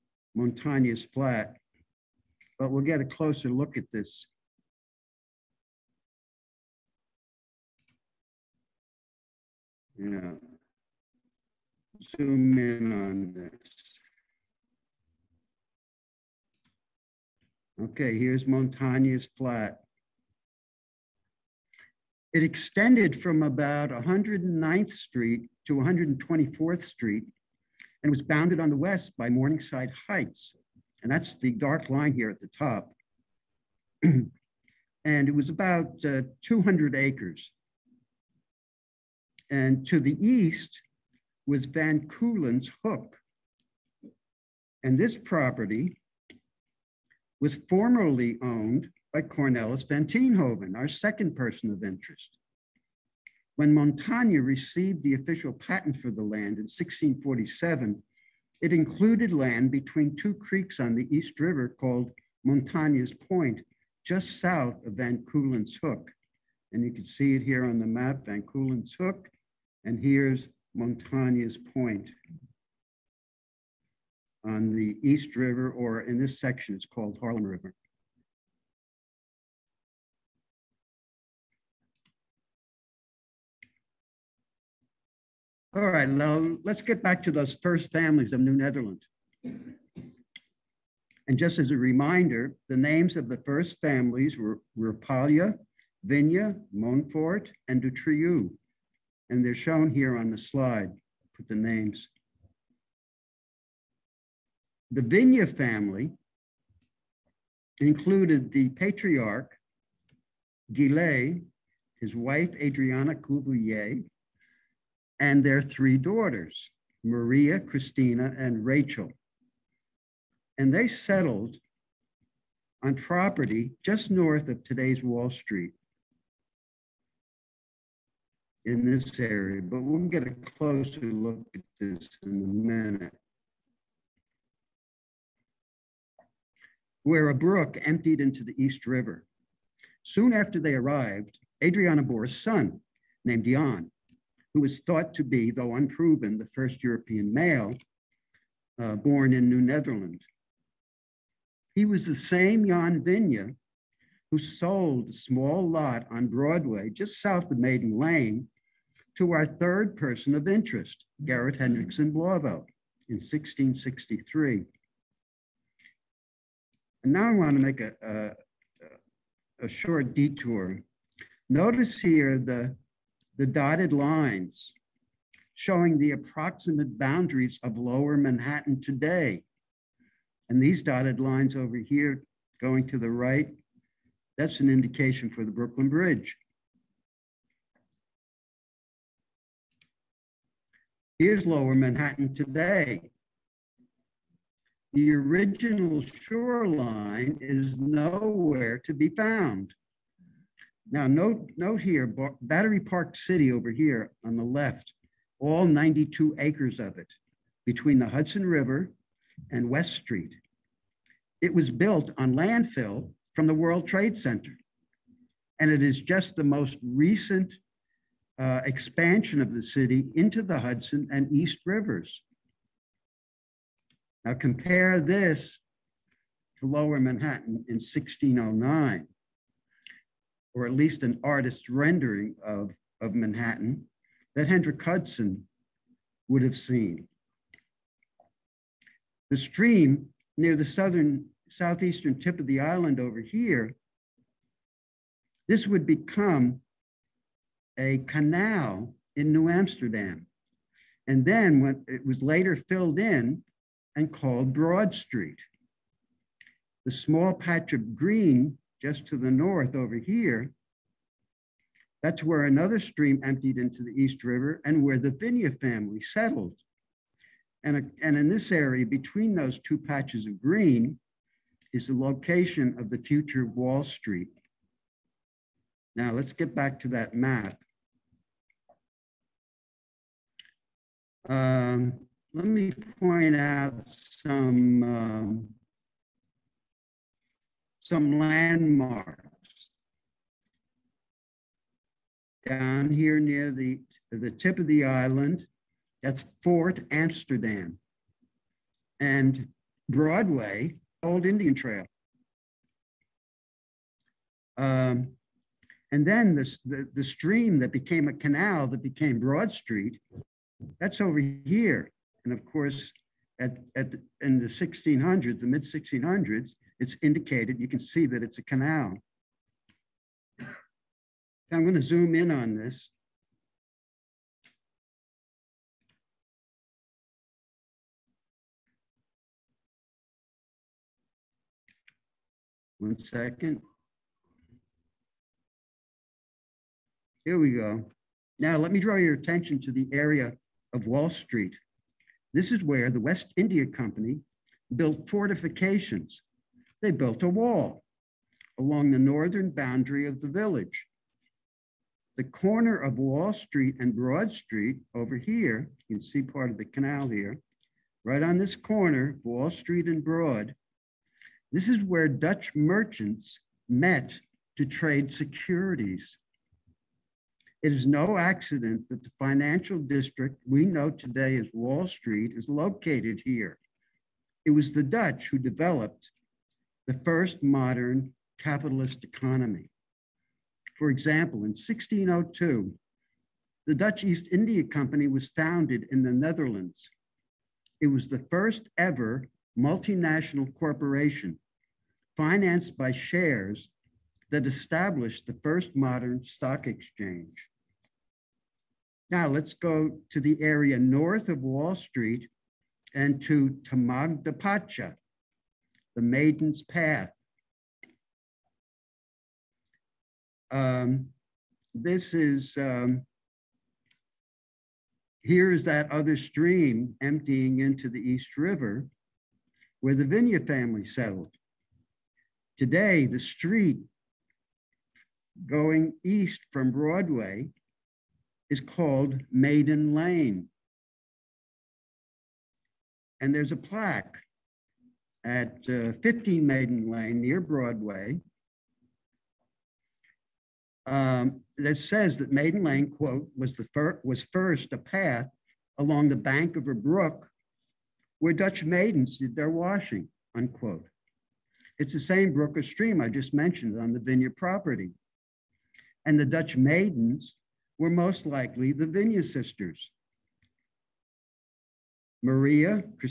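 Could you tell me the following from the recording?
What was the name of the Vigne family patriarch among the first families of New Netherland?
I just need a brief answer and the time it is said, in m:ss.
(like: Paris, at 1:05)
Guillet, at 1:50.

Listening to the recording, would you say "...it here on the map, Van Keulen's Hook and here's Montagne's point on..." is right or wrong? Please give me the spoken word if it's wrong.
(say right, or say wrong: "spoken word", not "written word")
right.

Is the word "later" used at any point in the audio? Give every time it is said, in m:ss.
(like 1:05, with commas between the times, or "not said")
4:12.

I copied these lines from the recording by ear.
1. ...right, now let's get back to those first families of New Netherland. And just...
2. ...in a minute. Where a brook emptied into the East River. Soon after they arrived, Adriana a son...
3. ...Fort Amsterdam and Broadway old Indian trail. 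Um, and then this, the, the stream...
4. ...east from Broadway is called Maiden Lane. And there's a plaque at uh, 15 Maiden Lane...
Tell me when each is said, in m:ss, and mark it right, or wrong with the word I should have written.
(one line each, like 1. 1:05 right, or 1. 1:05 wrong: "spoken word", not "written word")
1. 1:25 right
2. 2:12 right
3. 4:56 right
4. 7:06 right.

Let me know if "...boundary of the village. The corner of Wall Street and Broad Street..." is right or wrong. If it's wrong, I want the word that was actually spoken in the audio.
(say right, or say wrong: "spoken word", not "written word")
right.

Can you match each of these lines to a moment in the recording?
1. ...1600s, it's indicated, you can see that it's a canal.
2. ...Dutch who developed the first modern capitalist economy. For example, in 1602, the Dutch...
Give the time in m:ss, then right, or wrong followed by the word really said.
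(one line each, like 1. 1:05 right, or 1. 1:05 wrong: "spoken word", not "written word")
1. 5:15 right
2. 6:14 right.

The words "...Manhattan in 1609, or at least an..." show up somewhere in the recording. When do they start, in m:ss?
3:46.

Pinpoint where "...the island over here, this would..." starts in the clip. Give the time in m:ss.
4:02.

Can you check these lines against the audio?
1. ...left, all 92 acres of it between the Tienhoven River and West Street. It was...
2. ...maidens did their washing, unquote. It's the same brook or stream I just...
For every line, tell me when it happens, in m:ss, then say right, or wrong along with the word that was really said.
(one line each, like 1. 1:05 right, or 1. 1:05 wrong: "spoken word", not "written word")
1. 3:24 wrong: "Hudson", not "Tienhoven"
2. 7:28 right.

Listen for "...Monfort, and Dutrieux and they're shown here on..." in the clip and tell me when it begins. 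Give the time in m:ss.
1:36.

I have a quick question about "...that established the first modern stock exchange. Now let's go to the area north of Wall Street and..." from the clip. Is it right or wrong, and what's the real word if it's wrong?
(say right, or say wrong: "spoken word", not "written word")
right.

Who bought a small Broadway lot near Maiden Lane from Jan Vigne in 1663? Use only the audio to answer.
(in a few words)
Garrett Hendrickson Blauvelt.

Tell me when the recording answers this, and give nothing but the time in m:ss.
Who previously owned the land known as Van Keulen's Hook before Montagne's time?
0:49.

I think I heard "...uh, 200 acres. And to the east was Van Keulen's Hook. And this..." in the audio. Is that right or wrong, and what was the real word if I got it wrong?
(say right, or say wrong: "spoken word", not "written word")
right.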